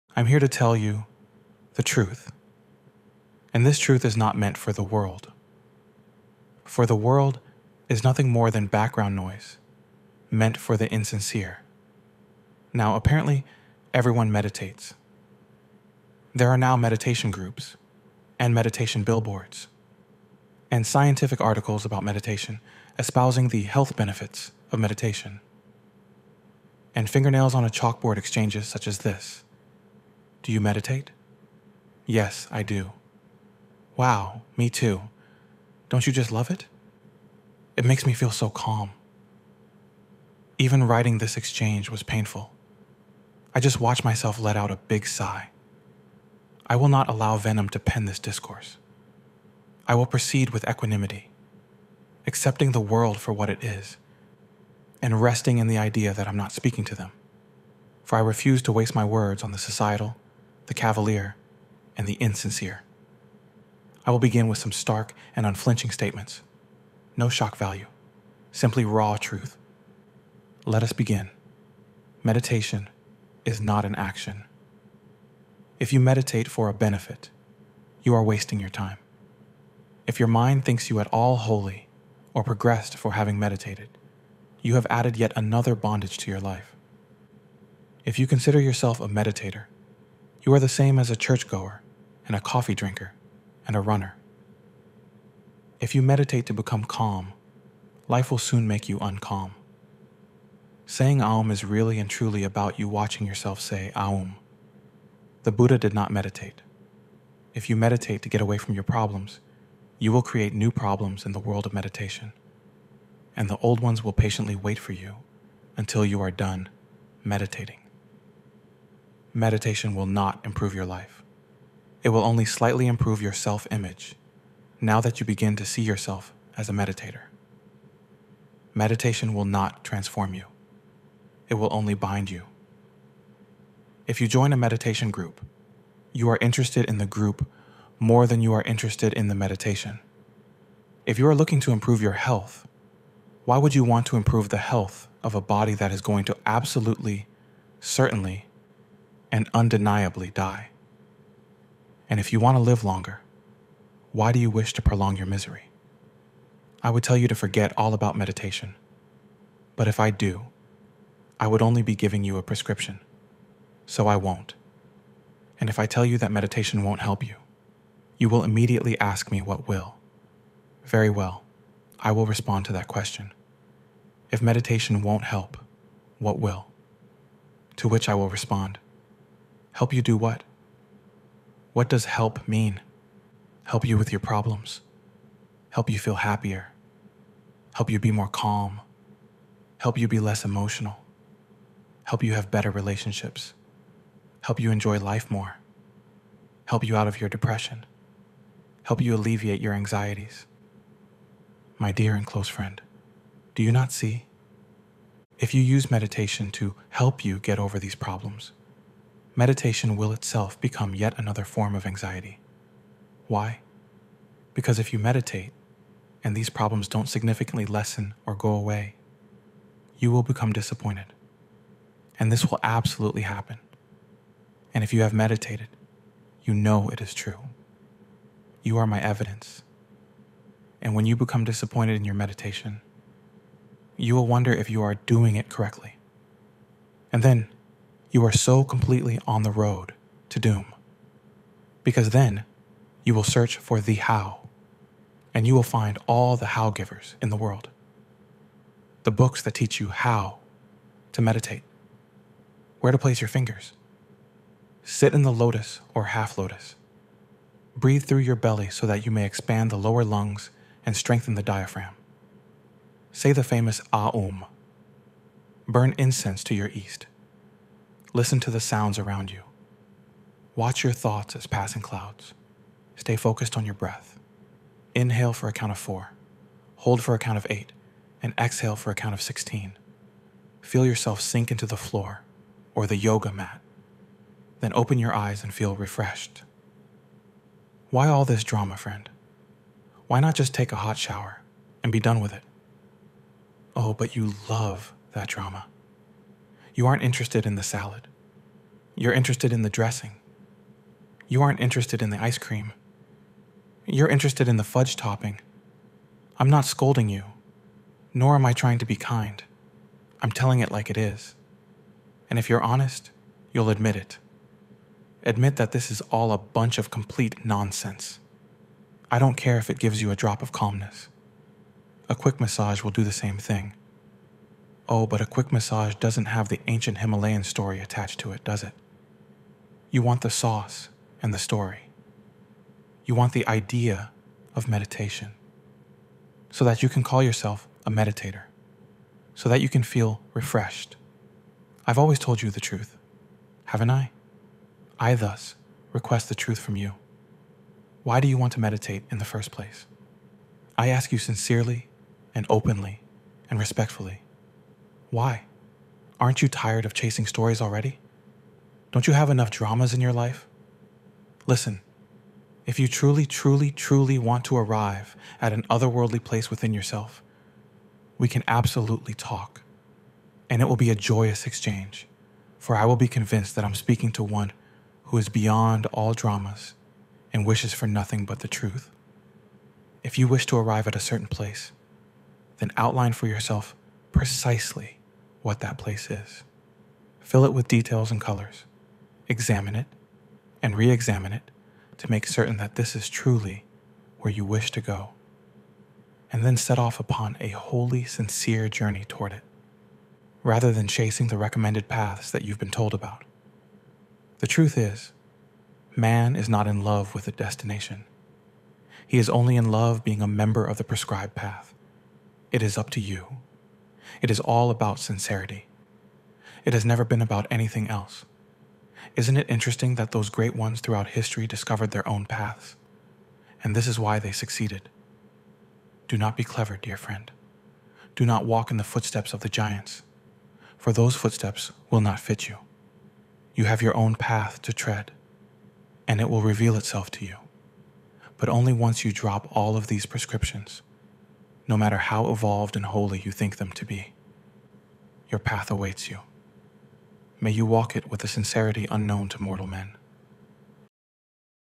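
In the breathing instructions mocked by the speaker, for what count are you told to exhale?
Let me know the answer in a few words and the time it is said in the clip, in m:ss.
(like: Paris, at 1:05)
16, at 4:38.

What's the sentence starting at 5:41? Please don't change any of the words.
I've always told you the truth, haven't I?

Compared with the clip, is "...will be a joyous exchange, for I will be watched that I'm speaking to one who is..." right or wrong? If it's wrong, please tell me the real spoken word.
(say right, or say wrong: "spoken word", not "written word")
wrong: "convinced", not "watched".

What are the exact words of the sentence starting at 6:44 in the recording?
The truth is, man is not in love with a destination.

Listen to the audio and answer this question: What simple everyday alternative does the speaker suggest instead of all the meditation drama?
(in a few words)
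hot shower.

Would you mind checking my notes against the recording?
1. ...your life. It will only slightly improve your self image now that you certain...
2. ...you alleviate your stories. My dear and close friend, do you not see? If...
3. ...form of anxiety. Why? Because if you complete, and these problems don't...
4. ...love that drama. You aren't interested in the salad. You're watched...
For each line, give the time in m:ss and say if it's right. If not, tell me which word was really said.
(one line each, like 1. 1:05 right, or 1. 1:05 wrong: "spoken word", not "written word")
1. 2:00 wrong: "begin", not "certain"
2. 3:19 wrong: "anxieties", not "stories"
3. 3:31 wrong: "meditate", not "complete"
4. 4:54 wrong: "interested", not "watched".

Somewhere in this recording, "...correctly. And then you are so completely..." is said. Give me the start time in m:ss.
3:55.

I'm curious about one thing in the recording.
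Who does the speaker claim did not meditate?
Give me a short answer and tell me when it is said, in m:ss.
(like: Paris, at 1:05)
The Buddha, at 1:45.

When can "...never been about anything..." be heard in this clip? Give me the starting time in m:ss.
6:56.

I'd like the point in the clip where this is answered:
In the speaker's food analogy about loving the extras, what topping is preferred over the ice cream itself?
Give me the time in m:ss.
5:04.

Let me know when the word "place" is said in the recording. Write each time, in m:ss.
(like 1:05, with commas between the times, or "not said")
4:12, 5:49, 6:06, 6:21, 6:25.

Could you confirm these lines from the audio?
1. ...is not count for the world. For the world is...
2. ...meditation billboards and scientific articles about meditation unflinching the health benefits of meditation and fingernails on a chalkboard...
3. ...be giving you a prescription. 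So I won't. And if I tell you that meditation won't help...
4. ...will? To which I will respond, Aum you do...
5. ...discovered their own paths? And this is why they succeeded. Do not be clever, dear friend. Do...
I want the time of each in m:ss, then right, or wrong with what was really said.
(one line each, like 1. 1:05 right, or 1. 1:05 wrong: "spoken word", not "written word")
1. 0:04 wrong: "meant", not "count"
2. 0:18 wrong: "espousing", not "unflinching"
3. 2:41 right
4. 2:56 wrong: "Help", not "Aum"
5. 7:01 right.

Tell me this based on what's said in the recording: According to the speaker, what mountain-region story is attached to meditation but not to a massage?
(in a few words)
ancient Himalayan.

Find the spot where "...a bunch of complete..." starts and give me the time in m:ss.
5:16.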